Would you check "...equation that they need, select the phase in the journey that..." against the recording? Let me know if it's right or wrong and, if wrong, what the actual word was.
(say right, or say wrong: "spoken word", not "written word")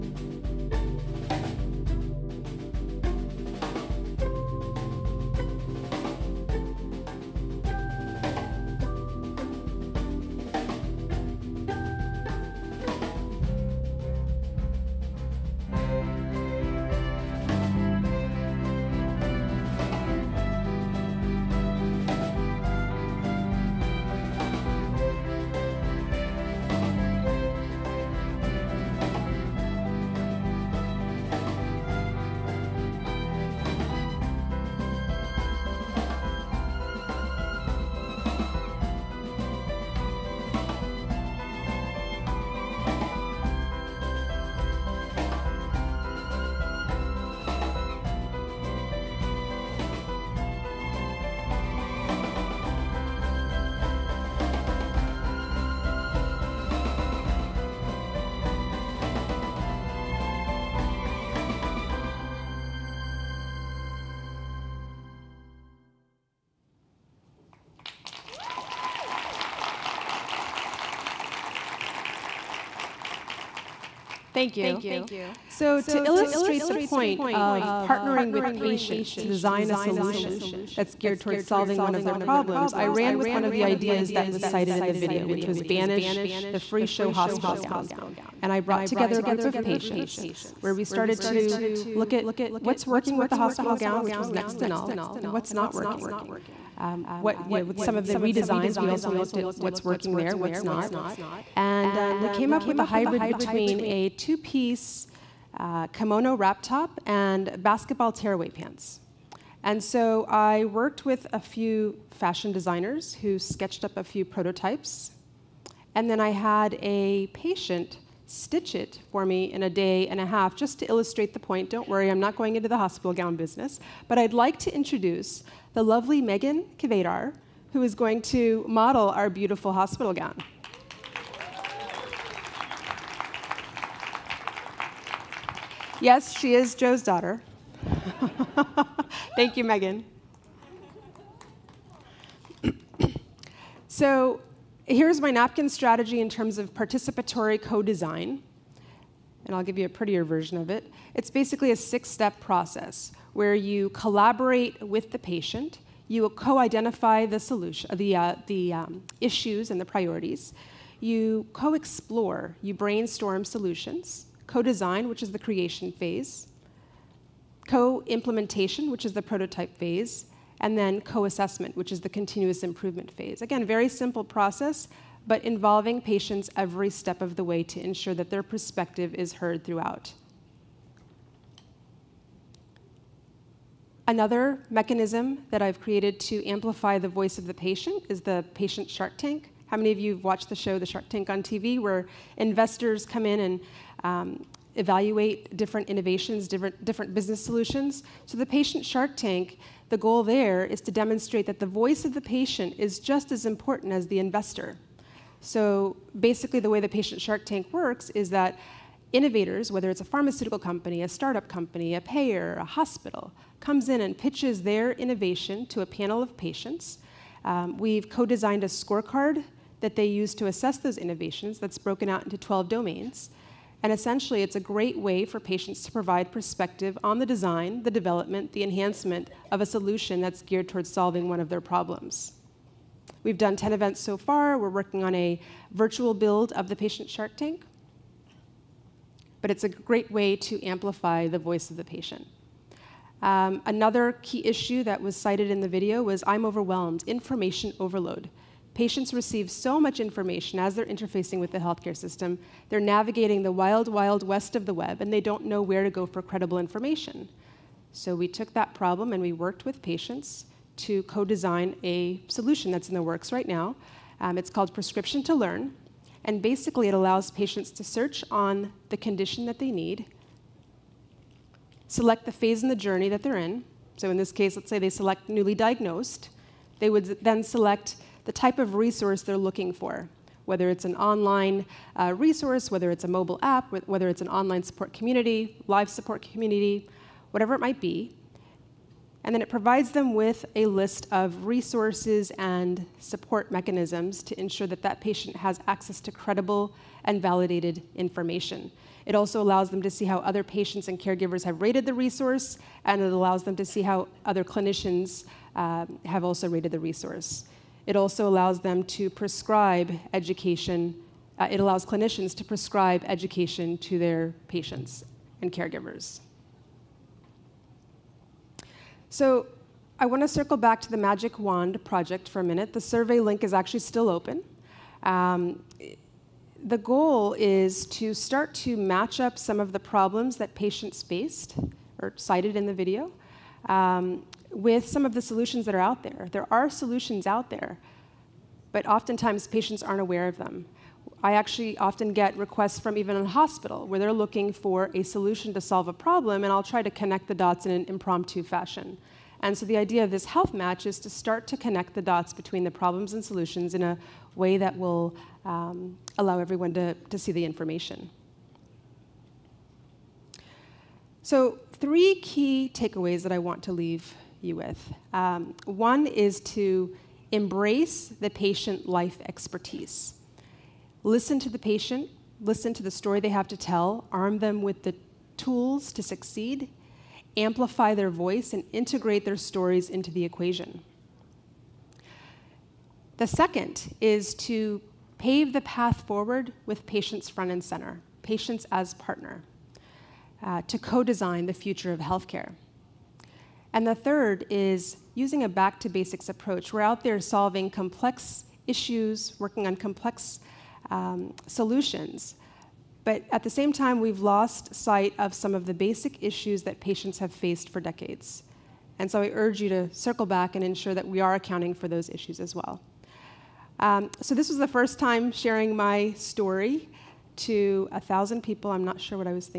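wrong: "condition", not "equation".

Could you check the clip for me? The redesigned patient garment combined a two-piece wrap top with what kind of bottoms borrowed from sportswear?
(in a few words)
Basketball tearaway pants.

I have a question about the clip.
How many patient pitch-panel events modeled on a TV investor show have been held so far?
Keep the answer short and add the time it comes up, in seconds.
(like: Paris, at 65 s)
10, at 233 s.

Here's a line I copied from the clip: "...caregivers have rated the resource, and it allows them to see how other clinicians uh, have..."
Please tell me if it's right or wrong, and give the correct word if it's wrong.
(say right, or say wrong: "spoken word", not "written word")
right.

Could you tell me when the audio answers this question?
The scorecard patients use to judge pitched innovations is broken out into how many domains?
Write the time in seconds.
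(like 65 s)
222 s.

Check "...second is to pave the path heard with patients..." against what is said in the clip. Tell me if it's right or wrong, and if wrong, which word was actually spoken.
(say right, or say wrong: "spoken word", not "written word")
wrong: "forward", not "heard".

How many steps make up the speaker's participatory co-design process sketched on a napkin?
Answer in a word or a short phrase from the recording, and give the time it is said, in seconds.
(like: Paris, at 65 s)
6, at 151 s.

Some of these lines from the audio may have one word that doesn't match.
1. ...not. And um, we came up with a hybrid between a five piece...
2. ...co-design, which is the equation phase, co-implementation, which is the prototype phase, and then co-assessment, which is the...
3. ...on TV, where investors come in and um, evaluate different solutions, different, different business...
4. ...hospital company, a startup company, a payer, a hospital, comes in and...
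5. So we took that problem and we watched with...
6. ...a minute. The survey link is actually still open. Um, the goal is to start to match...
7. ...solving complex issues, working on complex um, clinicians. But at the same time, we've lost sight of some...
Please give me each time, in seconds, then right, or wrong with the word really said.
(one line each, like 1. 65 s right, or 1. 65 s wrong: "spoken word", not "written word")
1. 100 s wrong: "two", not "five"
2. 164 s wrong: "creation", not "equation"
3. 191 s wrong: "innovations", not "solutions"
4. 210 s wrong: "pharmaceutical", not "hospital"
5. 257 s wrong: "worked", not "watched"
6. 322 s right
7. 397 s wrong: "solutions", not "clinicians".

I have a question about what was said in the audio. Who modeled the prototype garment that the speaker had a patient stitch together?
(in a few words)
Megan Kvedar.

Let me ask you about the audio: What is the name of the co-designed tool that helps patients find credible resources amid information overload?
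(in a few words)
Prescription to Learn.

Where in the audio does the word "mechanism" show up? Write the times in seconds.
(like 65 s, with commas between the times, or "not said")
184 s, 293 s.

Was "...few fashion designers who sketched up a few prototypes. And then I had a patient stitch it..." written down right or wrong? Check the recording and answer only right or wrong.
right.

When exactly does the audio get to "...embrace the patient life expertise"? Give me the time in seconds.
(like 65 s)
367 s.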